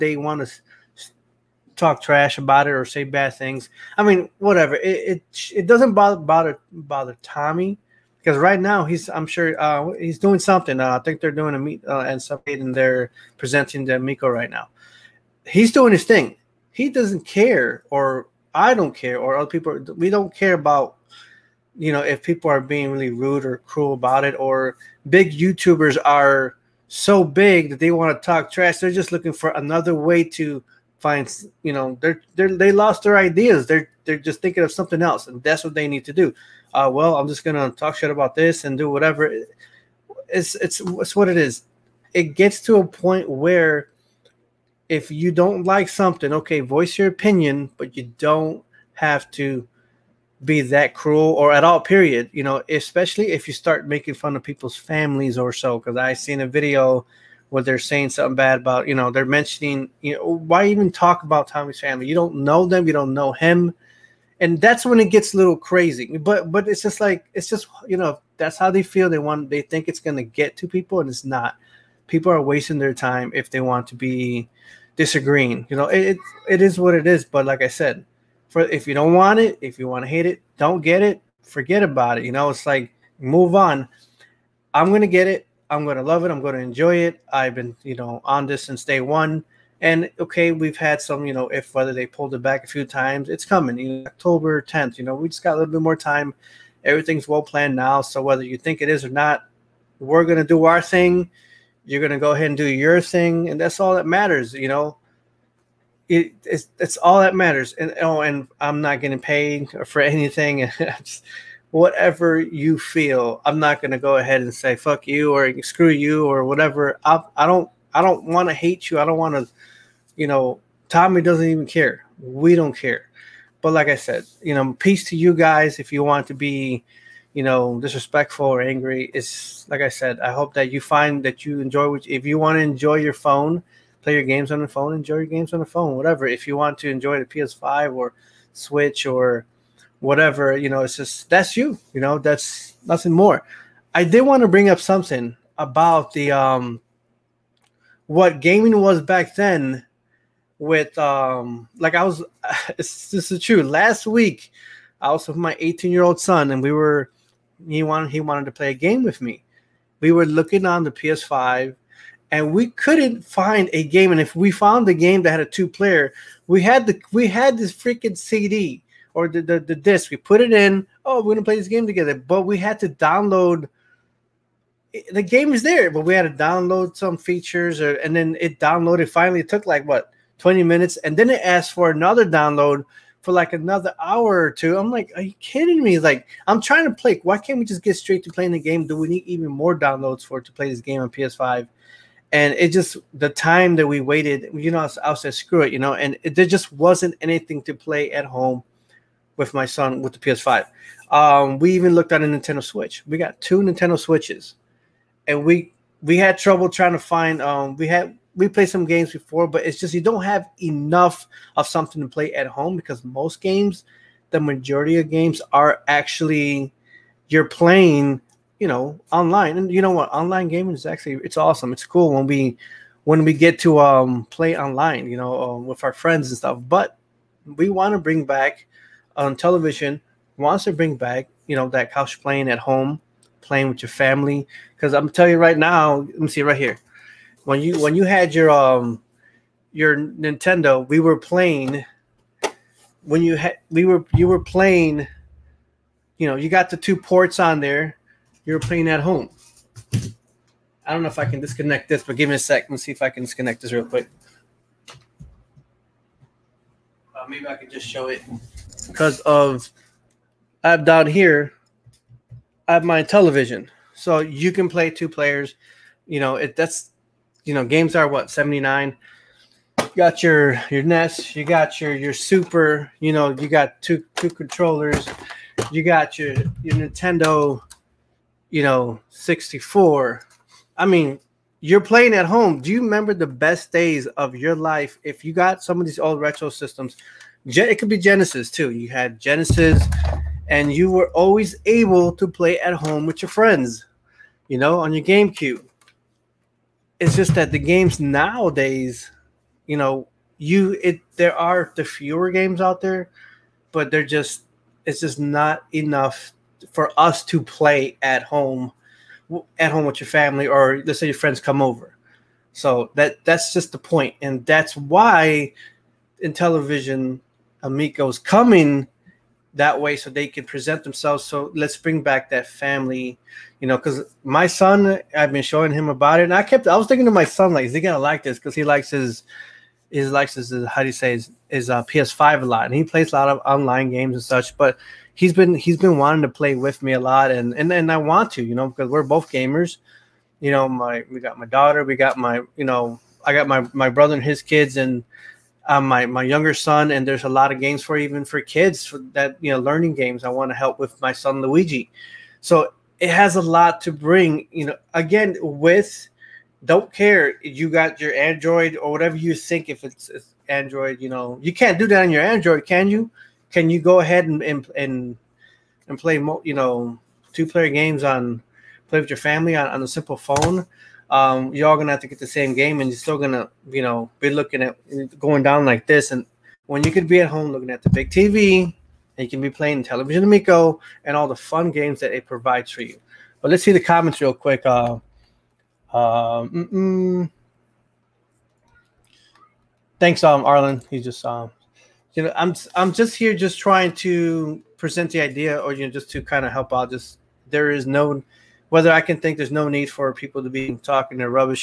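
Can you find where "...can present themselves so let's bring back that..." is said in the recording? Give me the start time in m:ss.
5:20.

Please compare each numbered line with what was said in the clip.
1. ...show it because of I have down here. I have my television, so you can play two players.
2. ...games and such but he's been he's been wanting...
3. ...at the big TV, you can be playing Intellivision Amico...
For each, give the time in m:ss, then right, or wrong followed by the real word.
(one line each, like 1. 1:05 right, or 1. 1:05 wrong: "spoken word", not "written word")
1. 4:17 right
2. 5:33 right
3. 6:17 right.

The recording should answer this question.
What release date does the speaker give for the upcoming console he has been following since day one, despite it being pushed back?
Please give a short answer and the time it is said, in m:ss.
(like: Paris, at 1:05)
October 10th, at 1:34.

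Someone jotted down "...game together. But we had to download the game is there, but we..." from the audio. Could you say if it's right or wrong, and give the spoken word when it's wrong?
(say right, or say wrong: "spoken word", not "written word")
right.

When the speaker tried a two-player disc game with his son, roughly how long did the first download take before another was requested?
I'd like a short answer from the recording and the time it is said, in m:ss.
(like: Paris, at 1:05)
20 minutes, at 3:00.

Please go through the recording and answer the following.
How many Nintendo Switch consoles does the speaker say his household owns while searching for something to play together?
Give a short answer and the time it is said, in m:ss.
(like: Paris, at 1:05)
2, at 3:23.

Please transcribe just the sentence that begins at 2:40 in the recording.
We were looking on the PS5 and we couldn't find a game.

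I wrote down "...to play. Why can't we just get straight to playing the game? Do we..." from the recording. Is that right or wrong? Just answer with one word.
right.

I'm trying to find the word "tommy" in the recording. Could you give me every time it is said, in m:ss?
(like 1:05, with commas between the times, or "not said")
0:07, 1:01, 2:00.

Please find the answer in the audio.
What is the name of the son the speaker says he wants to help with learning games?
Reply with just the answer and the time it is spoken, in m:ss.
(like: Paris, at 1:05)
Luigi, at 5:51.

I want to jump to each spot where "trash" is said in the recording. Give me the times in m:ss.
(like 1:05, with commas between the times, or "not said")
0:02, 0:28.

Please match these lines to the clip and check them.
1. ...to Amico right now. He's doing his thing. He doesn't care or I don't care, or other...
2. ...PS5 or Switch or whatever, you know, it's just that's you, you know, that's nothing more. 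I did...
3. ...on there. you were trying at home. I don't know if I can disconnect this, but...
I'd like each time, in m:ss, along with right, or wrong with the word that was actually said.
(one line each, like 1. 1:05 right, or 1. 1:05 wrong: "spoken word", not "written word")
1. 0:13 wrong: "Miko", not "Amico"
2. 2:17 right
3. 4:07 wrong: "playing", not "trying".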